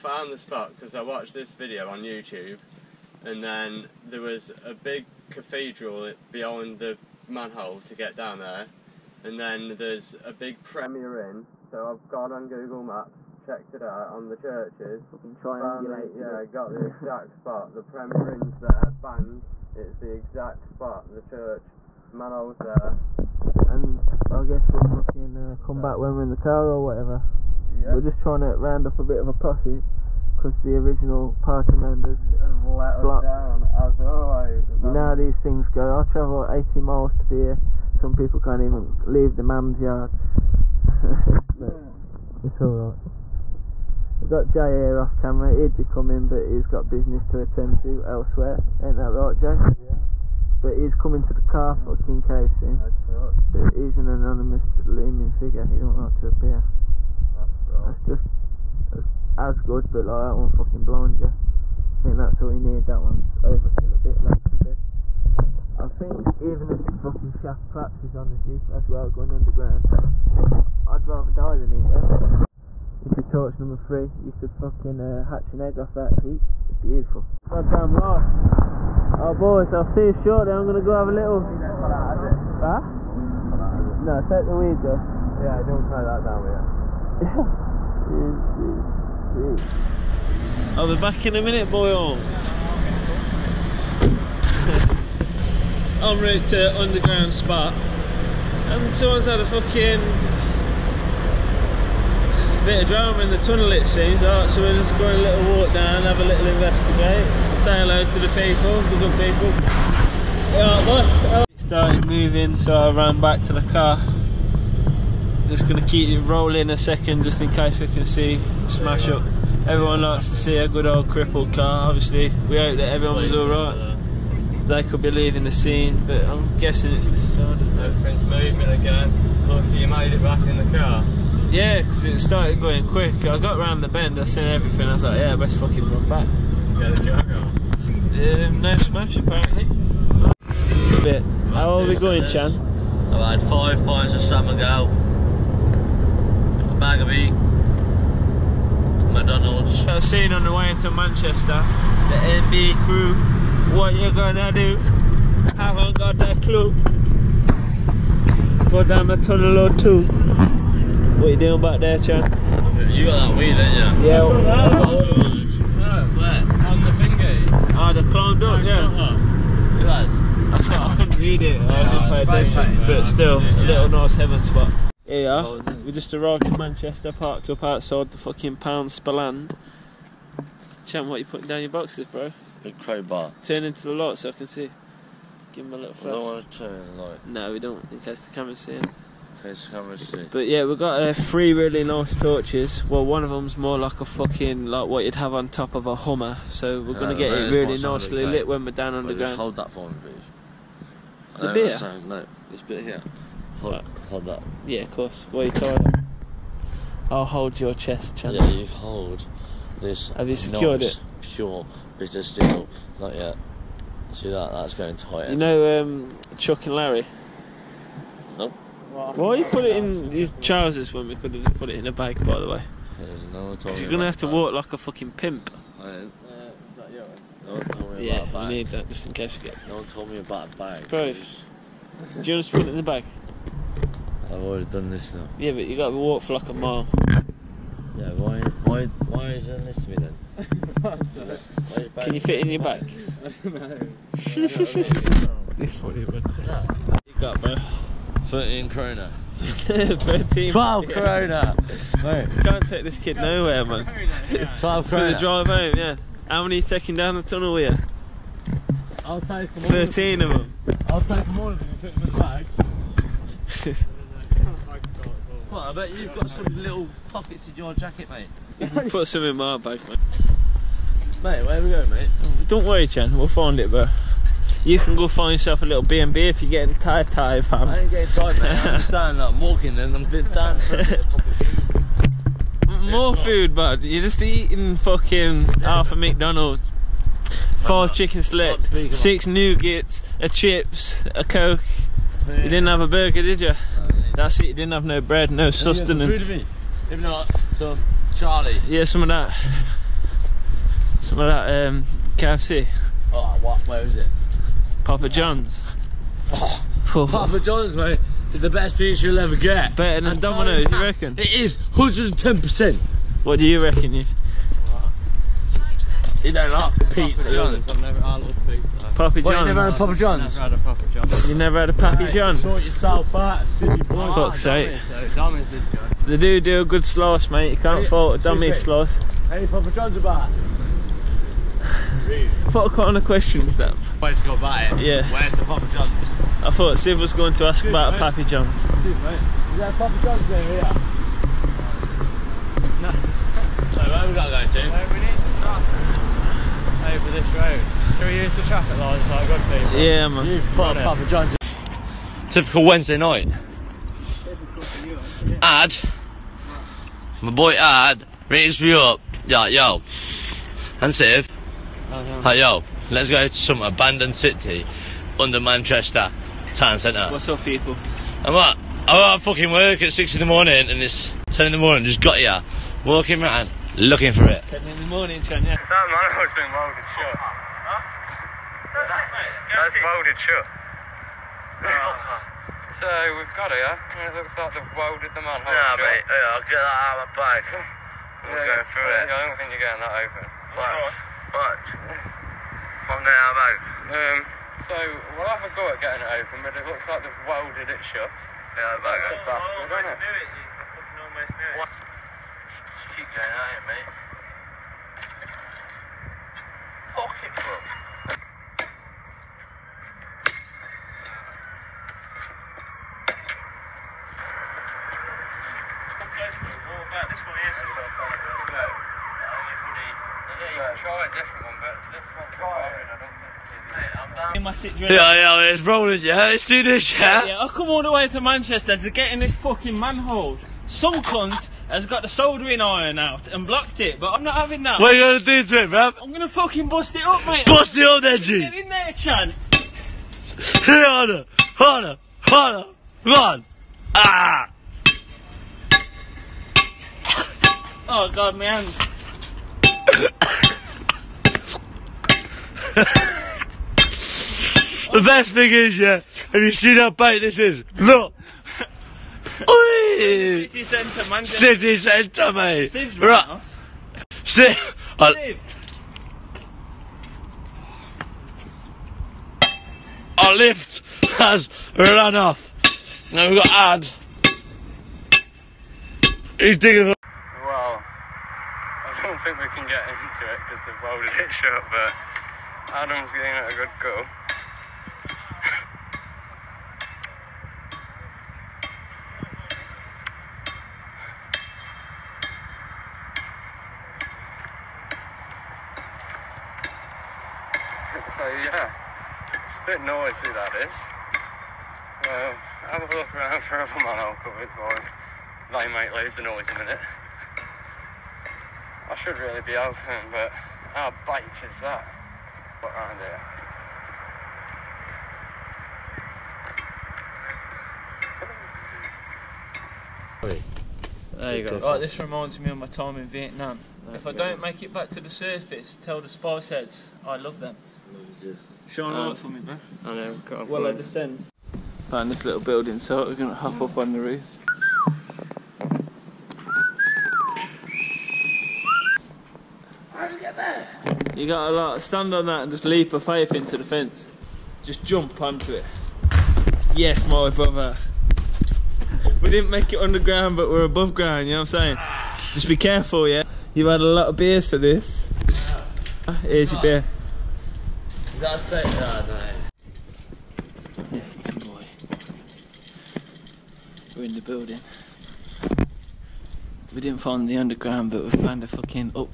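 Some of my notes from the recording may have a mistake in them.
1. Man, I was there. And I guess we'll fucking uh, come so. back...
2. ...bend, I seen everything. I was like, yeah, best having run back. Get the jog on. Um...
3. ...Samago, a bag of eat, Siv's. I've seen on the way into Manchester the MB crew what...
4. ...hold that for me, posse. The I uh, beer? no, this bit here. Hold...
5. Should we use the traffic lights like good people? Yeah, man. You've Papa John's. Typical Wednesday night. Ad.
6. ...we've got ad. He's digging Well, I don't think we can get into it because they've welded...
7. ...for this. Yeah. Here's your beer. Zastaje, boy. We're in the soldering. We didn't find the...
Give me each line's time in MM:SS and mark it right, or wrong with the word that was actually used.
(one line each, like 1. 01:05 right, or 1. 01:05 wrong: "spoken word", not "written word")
1. 00:22 right
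2. 02:13 wrong: "fucking", not "having"
3. 02:24 wrong: "McDonald", not "Siv"
4. 03:19 wrong: "please", not "posse"
5. 05:47 right
6. 07:53 right
7. 09:14 wrong: "building", not "soldering".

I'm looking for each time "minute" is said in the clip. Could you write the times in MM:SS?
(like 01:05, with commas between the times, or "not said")
01:31, 08:26.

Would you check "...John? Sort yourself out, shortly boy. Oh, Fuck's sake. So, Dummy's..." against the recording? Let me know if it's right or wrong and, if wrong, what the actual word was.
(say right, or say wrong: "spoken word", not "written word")
wrong: "silly", not "shortly".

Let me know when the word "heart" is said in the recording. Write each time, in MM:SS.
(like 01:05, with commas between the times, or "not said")
not said.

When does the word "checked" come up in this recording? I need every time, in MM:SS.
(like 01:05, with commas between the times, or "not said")
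00:13.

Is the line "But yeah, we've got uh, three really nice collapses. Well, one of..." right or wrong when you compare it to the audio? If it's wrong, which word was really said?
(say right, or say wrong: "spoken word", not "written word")
wrong: "torches", not "collapses".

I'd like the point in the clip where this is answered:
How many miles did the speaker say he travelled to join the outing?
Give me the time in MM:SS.
00:36.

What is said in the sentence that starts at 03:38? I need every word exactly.
Well, Why you put it in his trousers when we could have put it in a bag?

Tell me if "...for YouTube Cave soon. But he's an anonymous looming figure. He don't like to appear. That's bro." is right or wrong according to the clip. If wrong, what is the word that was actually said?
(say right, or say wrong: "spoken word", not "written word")
wrong: "King", not "YouTube".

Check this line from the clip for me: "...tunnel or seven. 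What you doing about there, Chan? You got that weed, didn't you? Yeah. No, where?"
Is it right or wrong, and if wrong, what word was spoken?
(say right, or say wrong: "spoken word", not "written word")
wrong: "two", not "seven".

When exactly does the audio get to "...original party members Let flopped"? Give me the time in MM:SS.
00:30.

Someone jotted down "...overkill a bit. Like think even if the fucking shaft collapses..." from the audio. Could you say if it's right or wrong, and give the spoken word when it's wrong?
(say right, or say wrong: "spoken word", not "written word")
right.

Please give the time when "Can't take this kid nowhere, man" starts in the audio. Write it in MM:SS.
04:12.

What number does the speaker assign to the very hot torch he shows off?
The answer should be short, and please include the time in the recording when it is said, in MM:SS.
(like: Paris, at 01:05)
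3, at 01:13.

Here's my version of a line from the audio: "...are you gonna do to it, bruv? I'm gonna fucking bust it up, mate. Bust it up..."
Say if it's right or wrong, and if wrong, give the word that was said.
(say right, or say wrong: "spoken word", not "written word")
right.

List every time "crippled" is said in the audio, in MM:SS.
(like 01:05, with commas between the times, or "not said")
02:01.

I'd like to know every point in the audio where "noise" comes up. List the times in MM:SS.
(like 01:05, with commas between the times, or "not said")
08:19, 08:26.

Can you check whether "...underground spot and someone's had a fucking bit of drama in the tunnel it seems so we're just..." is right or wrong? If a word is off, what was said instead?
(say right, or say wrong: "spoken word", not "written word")
right.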